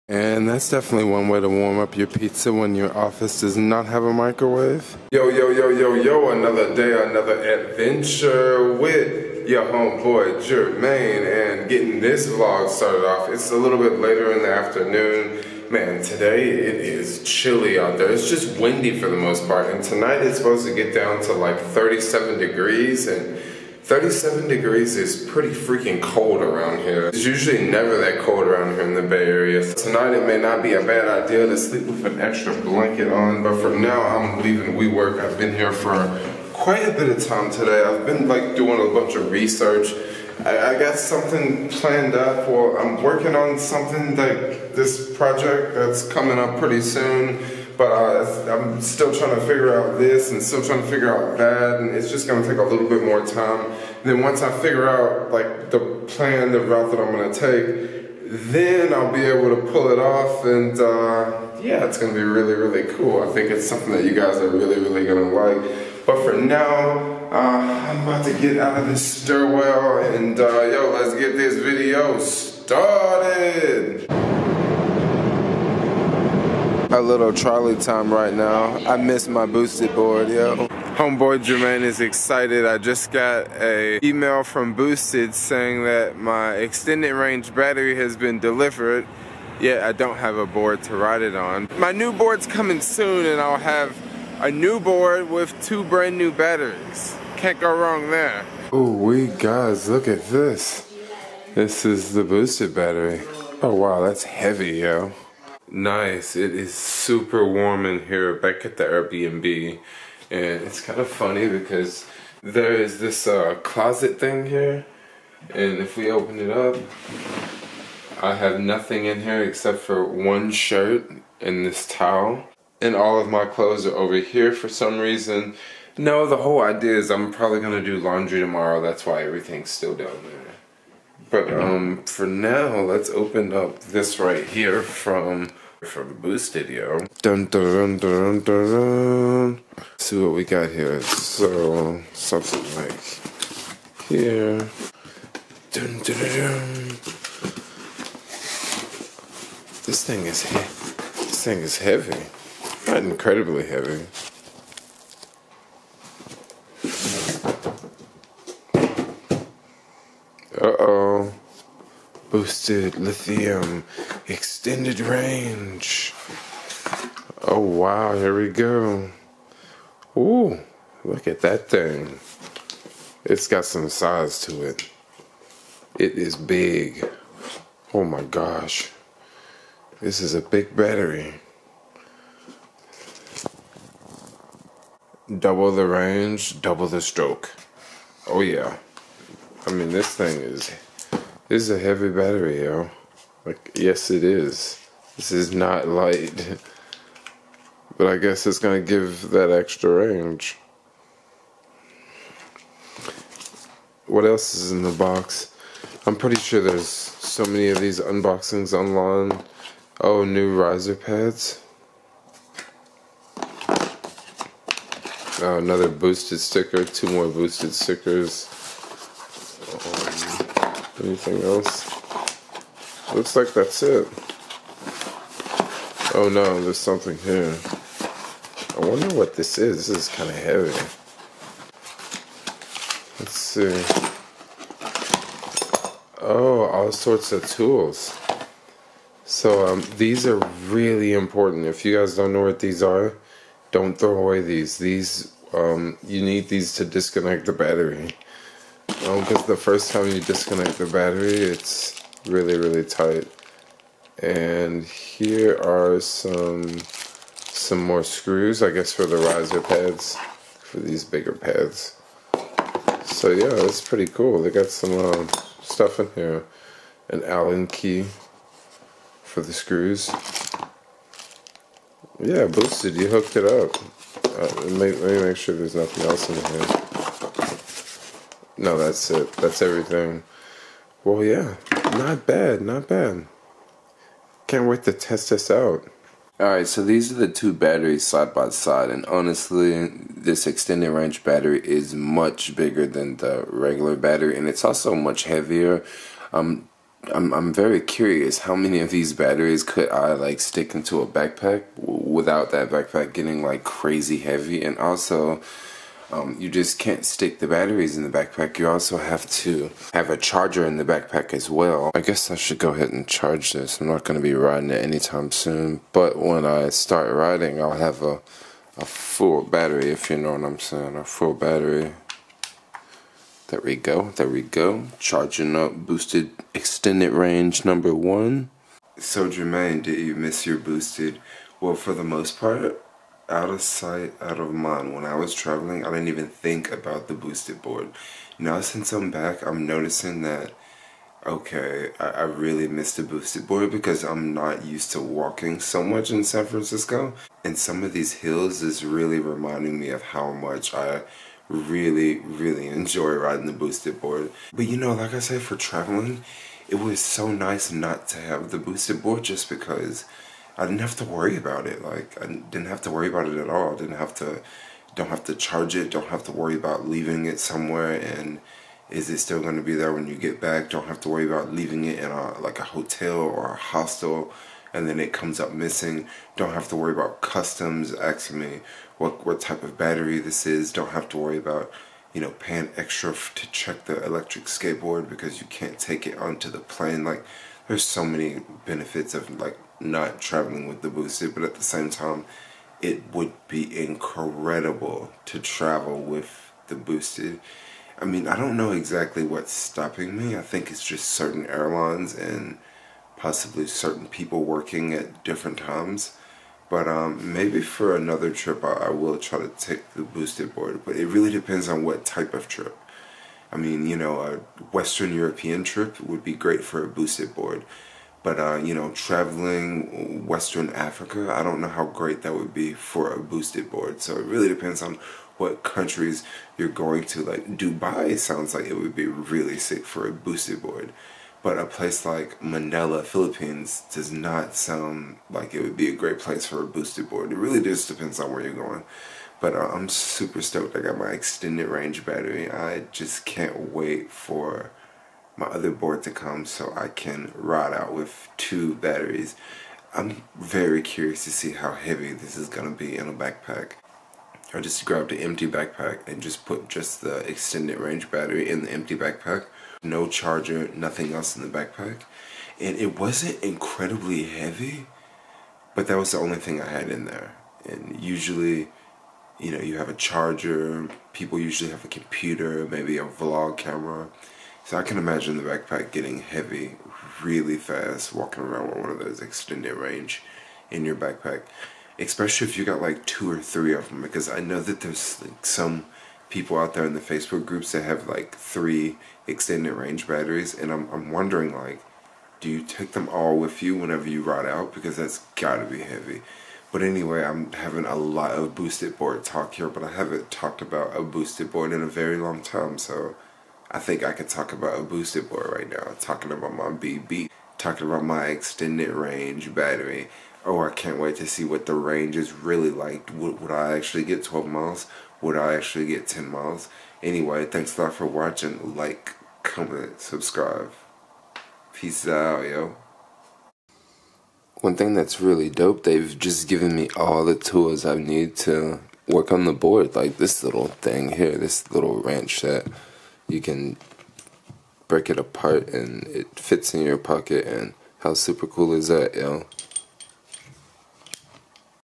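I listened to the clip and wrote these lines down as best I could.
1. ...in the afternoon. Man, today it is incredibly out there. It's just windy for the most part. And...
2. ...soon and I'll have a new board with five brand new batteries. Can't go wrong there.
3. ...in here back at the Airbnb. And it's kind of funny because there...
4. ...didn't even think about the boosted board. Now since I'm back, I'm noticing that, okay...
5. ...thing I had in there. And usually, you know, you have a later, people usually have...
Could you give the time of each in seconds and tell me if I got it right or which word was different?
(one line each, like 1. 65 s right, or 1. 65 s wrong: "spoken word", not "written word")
1. 14 s wrong: "chilly", not "incredibly"
2. 92 s wrong: "two", not "five"
3. 107 s right
4. 335 s right
5. 466 s wrong: "charger", not "later".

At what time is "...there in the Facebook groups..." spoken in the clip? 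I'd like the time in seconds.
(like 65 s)
486 s.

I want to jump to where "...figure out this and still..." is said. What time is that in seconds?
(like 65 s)
49 s.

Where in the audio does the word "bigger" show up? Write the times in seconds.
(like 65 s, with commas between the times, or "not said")
261 s, 292 s.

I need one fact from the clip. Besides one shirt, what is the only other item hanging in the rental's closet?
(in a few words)
towel.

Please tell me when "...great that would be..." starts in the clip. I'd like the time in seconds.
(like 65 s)
421 s.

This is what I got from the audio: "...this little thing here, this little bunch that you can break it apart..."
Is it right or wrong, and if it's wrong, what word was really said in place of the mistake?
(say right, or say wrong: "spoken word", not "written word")
wrong: "wrench", not "bunch".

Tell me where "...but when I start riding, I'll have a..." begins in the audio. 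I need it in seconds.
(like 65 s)
315 s.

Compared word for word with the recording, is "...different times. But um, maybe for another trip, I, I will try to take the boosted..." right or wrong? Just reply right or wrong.
right.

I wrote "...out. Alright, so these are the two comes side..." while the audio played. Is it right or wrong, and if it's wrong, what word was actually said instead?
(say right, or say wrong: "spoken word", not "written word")
wrong: "batteries", not "comes".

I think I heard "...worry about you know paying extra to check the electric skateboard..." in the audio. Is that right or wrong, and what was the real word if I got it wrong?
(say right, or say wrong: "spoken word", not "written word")
right.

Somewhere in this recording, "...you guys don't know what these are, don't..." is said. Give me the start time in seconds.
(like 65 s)
241 s.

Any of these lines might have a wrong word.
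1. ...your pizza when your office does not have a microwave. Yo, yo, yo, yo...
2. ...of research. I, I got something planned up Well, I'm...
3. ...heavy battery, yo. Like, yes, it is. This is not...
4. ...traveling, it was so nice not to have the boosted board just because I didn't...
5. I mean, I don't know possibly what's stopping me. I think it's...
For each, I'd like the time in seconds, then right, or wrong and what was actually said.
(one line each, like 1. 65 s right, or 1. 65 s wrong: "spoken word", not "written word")
1. 1 s right
2. 39 s right
3. 191 s right
4. 355 s right
5. 397 s wrong: "exactly", not "possibly".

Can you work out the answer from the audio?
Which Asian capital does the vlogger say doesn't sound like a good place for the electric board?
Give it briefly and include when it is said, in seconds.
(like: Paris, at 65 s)
Manila, at 432 s.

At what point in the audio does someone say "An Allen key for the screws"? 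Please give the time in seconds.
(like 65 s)
267 s.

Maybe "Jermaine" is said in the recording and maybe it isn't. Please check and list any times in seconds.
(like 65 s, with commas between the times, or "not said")
10 s, 81 s, 329 s.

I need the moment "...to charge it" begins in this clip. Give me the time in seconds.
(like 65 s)
365 s.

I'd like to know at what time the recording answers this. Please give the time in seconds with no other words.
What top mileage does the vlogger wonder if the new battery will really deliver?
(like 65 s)
514 s.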